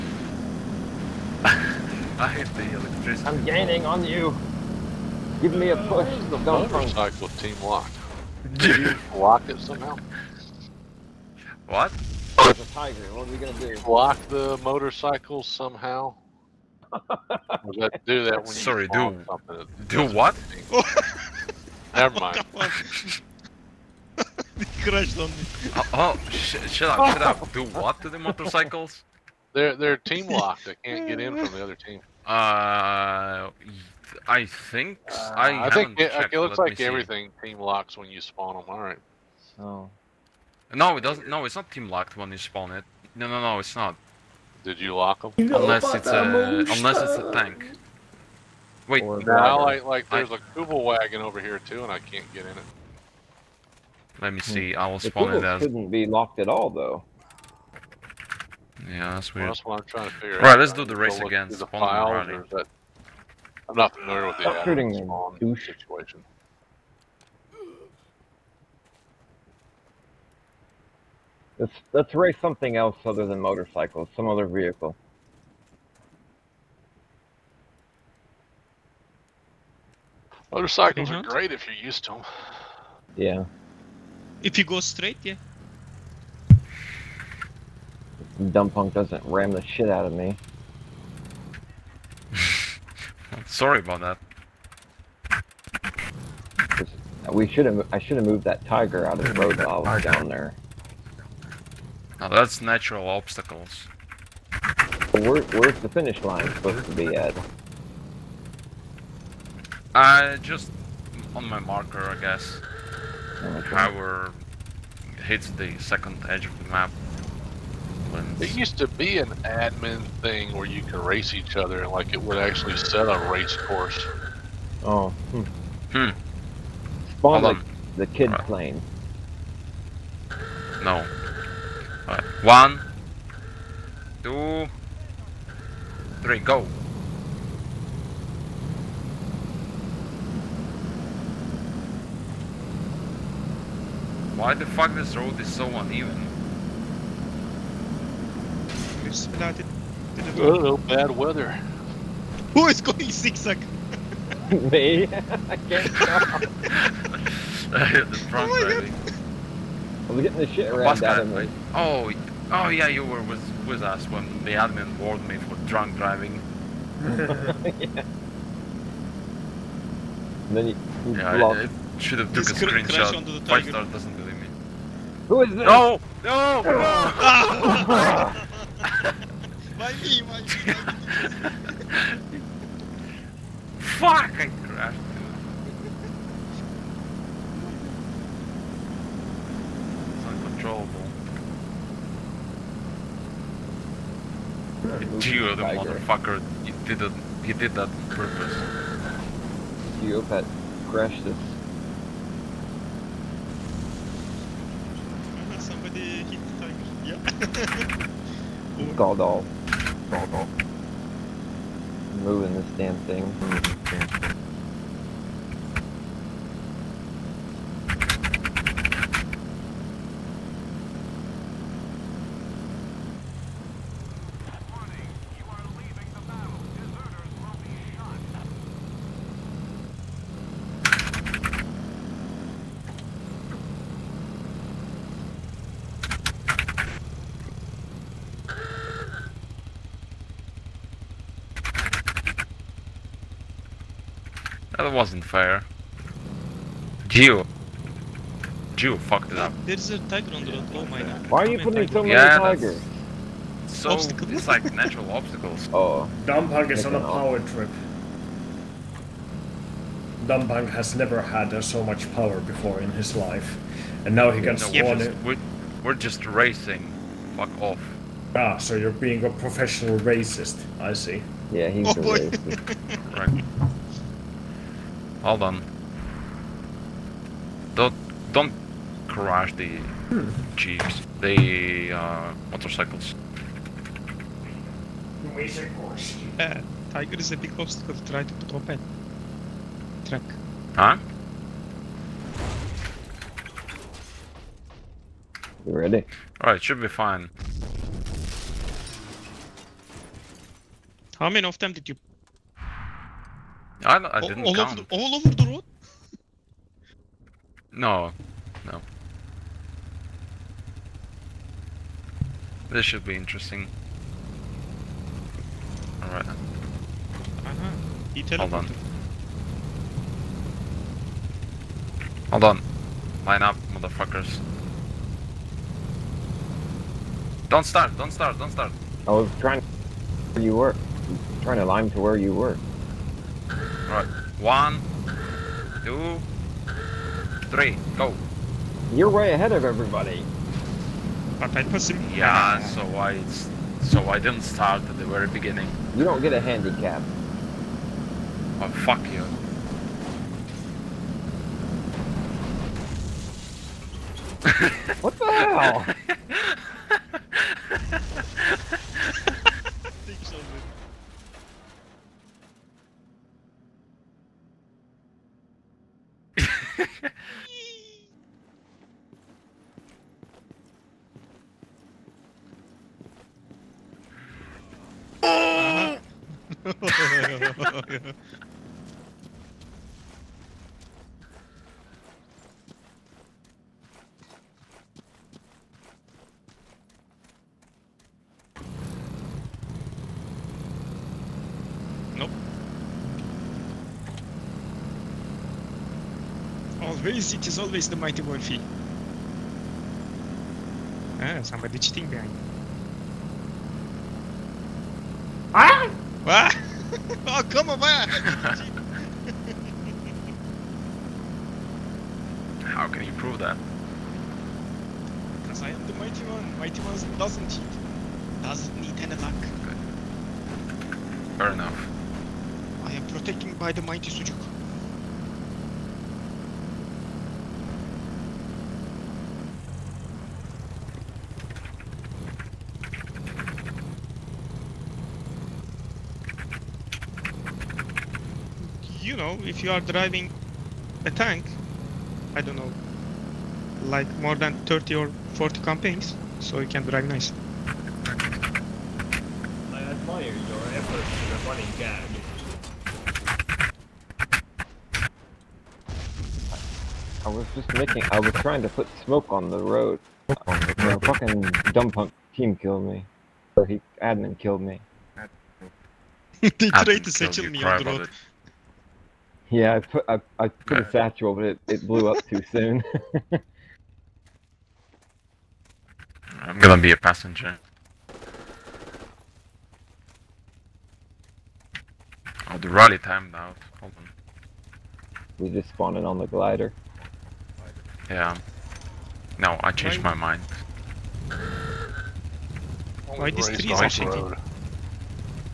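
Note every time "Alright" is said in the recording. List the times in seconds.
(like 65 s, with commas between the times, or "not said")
296 s, 316 s.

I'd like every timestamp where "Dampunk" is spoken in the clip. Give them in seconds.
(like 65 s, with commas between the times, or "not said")
256 s, 260 s.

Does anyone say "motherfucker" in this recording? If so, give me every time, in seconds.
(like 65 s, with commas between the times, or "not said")
195 s, 323 s.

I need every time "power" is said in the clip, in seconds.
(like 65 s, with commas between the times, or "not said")
113 s, 256 s, 262 s.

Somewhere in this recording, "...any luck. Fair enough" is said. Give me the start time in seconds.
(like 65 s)
418 s.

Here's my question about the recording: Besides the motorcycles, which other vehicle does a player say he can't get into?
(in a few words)
Kübelwagen.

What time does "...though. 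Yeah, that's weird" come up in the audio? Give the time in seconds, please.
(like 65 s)
56 s.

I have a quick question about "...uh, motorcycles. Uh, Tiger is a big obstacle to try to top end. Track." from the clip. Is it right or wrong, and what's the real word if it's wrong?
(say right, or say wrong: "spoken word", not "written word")
right.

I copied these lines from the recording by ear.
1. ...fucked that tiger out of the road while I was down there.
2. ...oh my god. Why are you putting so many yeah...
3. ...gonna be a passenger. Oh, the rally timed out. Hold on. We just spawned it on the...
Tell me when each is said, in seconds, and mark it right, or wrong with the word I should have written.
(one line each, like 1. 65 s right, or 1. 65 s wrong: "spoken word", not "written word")
1. 98 s wrong: "moved", not "fucked"
2. 250 s right
3. 476 s right.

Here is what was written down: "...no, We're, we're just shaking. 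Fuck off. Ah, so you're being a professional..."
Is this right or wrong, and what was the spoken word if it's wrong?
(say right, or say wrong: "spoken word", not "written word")
wrong: "racing", not "shaking".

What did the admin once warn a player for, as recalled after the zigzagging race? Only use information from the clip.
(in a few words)
drunk driving.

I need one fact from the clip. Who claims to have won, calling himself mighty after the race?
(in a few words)
Wolfie.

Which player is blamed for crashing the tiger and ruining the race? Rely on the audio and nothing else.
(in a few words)
Geopat.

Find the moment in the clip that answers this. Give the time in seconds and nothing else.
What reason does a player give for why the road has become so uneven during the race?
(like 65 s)
150 s.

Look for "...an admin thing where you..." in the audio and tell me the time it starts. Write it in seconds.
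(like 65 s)
119 s.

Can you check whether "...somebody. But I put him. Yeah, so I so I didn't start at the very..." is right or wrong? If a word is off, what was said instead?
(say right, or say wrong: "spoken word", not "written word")
wrong: "everybody", not "somebody".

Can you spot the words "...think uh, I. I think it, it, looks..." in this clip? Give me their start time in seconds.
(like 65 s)
34 s.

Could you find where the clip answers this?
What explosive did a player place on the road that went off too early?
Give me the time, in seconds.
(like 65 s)
470 s.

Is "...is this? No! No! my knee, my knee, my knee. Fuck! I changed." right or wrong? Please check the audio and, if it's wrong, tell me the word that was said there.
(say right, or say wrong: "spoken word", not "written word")
wrong: "crashed", not "changed".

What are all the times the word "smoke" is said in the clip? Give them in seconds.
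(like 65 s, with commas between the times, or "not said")
459 s.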